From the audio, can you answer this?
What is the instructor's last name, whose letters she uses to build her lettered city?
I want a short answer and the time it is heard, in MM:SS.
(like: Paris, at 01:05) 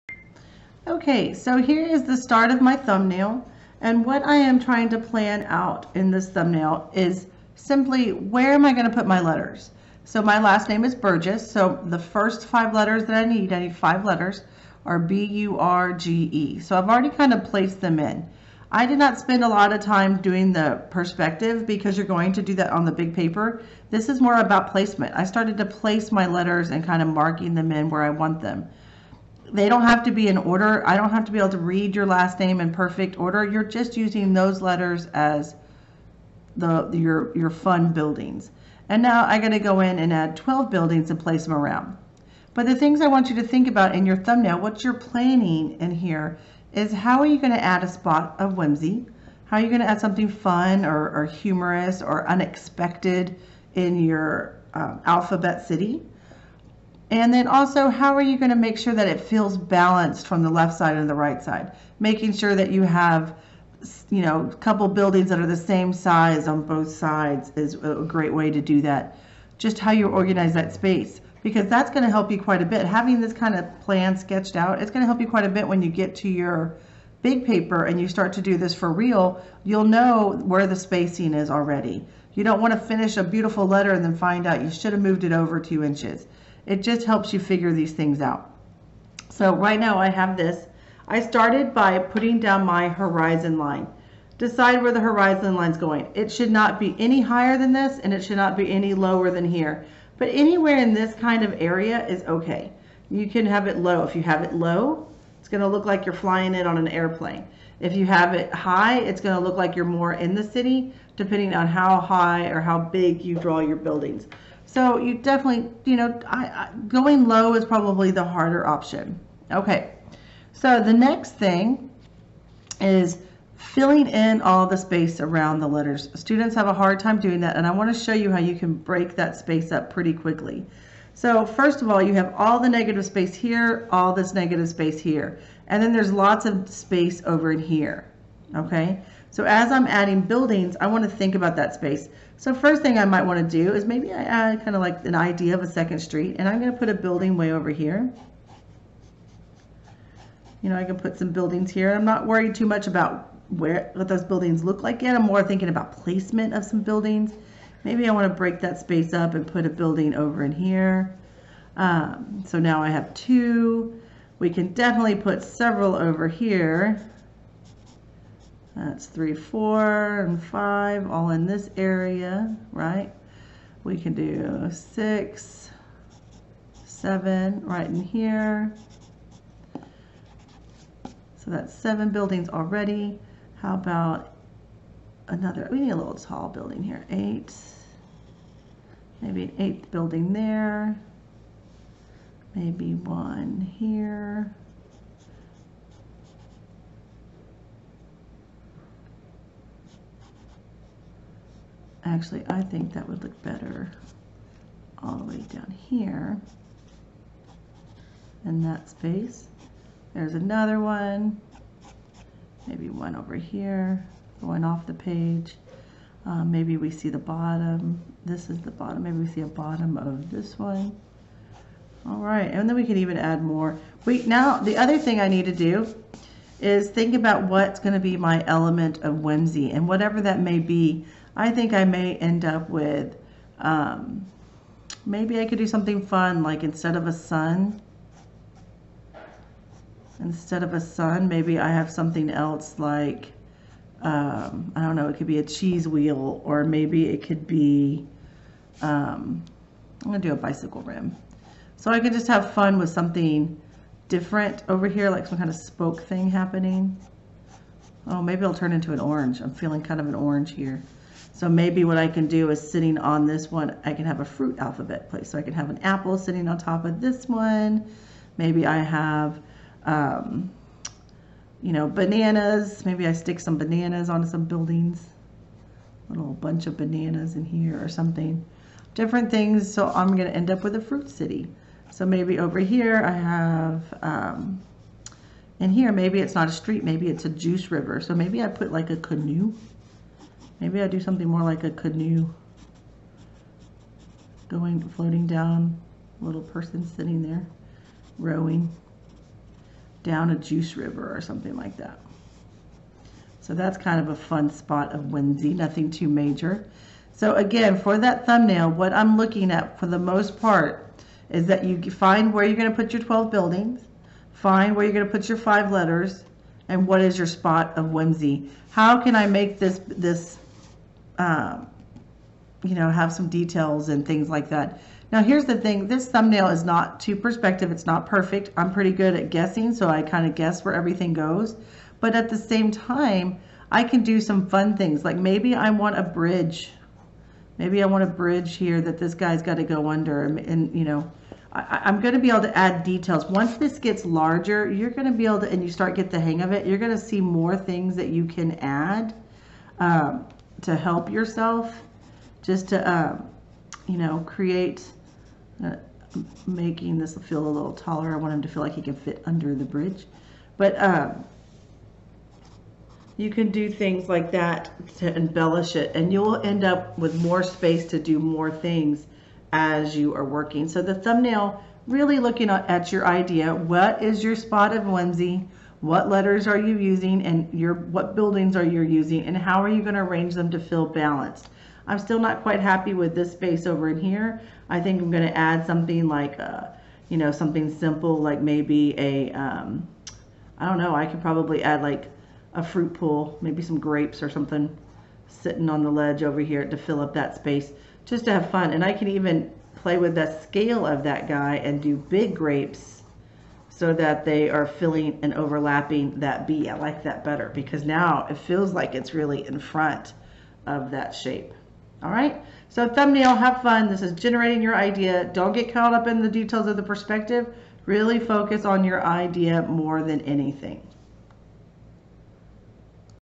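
Burgess, at 00:10.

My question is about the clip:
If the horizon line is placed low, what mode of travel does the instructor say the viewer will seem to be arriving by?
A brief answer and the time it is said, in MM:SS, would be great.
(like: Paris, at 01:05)
airplane, at 01:46.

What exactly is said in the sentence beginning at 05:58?
I want him to feel like he can fit under the bridge.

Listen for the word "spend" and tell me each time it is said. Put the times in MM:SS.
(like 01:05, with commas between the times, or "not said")
00:19.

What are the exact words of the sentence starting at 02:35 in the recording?
I'm more thinking about placement of some buildings.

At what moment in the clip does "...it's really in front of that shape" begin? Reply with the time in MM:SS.
06:48.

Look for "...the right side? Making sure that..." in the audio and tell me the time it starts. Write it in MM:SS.
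01:01.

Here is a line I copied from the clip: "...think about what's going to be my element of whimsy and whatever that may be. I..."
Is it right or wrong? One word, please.
right.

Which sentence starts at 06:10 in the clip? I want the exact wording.
So the thumbnail, really looking at your idea, what is your spot of whimsy?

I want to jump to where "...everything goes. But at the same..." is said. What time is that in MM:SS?
05:30.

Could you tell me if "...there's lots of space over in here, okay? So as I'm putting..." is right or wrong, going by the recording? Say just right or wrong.
wrong.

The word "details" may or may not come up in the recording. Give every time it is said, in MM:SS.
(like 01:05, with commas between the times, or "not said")
05:23, 05:42, 06:56.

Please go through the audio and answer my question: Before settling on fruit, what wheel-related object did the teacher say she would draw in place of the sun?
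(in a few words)
bicycle rim.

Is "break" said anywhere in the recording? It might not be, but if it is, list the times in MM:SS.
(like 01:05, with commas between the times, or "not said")
02:08, 02:38.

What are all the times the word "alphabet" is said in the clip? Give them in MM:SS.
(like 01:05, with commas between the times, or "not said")
00:55, 04:24.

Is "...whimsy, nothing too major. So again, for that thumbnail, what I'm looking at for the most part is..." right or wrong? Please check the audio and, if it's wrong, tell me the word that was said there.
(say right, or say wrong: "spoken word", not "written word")
right.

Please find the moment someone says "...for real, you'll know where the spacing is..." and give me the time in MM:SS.
01:18.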